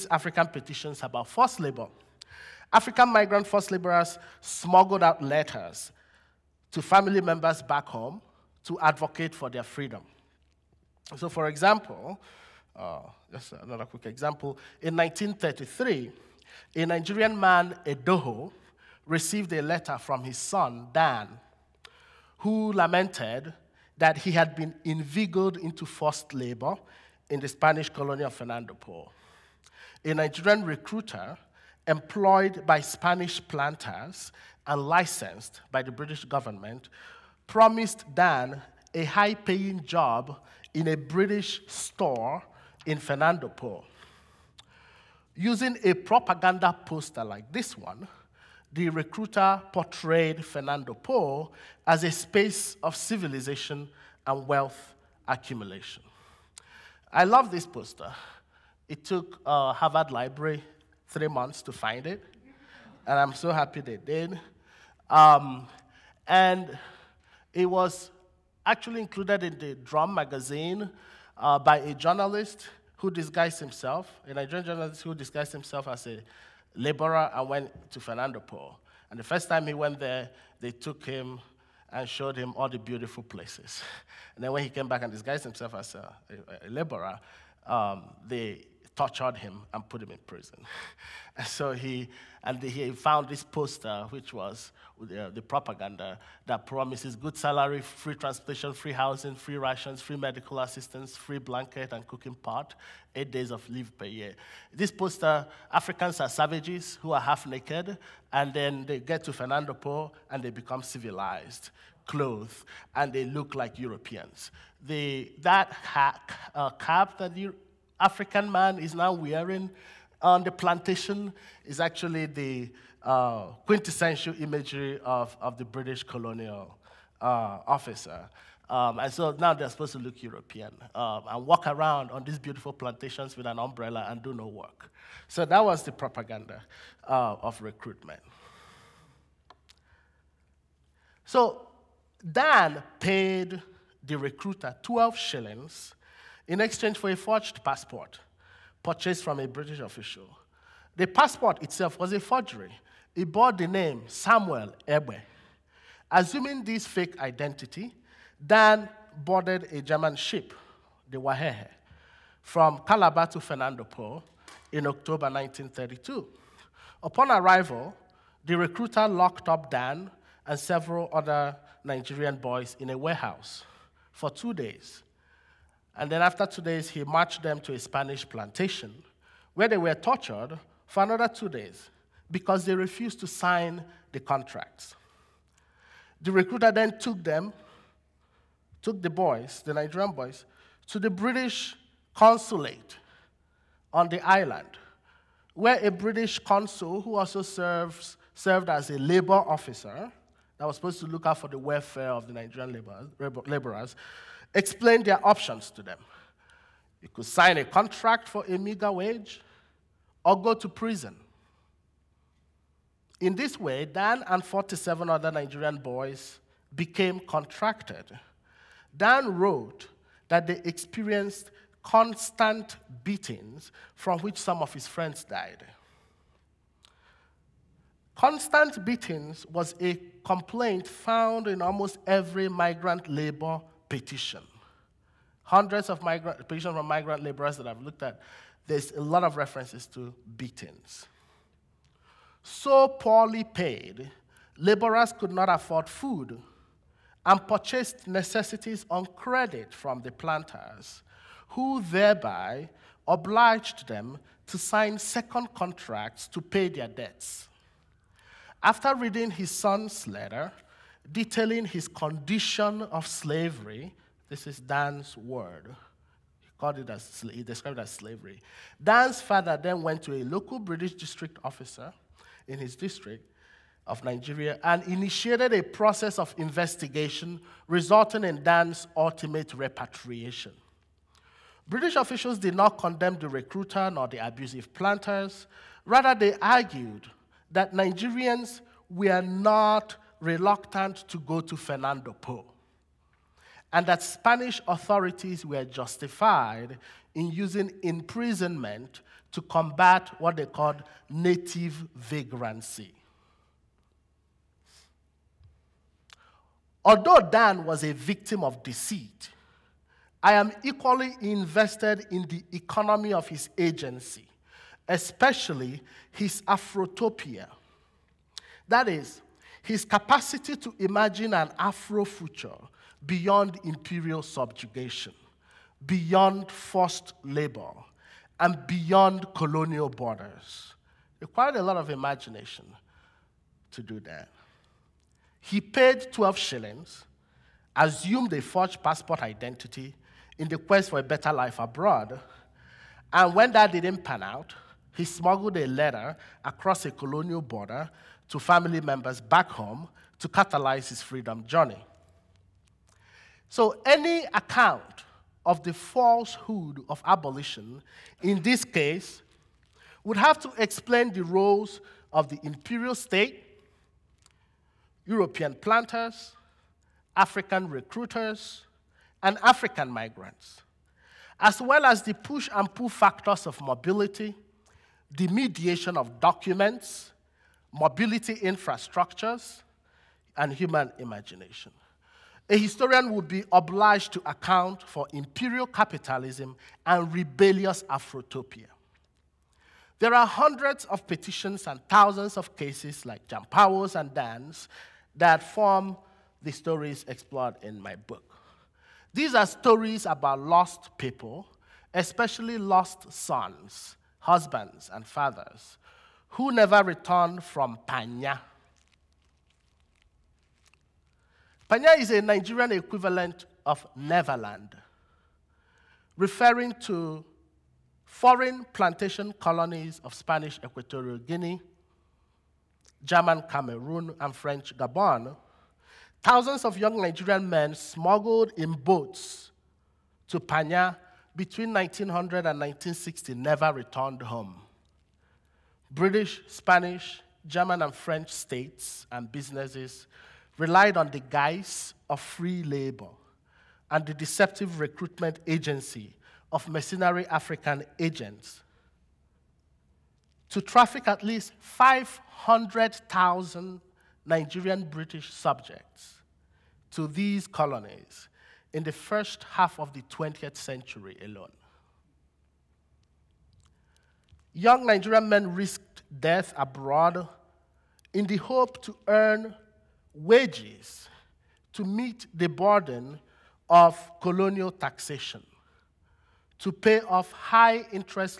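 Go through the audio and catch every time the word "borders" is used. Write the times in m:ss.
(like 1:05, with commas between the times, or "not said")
5:29, 5:47.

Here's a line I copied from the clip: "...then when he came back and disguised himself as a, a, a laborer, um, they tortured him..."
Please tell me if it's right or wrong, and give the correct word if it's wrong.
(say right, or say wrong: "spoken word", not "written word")
right.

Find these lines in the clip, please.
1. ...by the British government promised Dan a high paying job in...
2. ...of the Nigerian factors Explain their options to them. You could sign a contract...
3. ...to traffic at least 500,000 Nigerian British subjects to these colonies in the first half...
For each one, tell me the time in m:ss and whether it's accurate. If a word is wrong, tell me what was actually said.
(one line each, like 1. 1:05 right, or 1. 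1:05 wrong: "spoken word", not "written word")
1. 0:35 right
2. 3:22 wrong: "laborers", not "factors"
3. 7:30 right.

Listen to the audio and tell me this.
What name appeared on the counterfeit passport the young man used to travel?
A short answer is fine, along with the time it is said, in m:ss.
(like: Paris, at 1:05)
Samuel Ebwe, at 2:34.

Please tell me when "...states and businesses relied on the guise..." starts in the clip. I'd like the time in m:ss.
7:18.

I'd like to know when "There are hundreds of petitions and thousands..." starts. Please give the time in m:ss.
6:29.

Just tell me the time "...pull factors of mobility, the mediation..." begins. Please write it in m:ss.
6:12.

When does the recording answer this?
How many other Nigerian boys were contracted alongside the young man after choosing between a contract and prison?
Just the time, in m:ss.
3:34.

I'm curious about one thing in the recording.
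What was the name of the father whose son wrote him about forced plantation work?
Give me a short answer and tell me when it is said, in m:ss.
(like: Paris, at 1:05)
Edoho, at 0:17.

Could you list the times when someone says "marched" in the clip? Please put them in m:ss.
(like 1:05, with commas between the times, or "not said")
2:57.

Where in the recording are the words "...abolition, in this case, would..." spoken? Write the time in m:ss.
5:57.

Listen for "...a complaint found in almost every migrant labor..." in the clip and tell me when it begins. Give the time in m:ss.
3:49.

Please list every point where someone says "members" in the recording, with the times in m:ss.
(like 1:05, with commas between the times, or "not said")
0:07, 5:48.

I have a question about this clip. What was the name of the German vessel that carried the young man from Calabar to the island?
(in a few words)
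Wahehe.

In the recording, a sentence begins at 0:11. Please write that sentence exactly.
So, for example, uh, just another quick example.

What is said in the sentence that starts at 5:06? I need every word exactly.
Although Dan was a victim of deceit, I am equally invested in the economy of his agency, especially his Afrotopia.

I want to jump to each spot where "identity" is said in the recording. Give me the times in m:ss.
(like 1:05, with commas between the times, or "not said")
2:37, 5:39.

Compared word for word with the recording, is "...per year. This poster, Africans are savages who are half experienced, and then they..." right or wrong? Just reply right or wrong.
wrong.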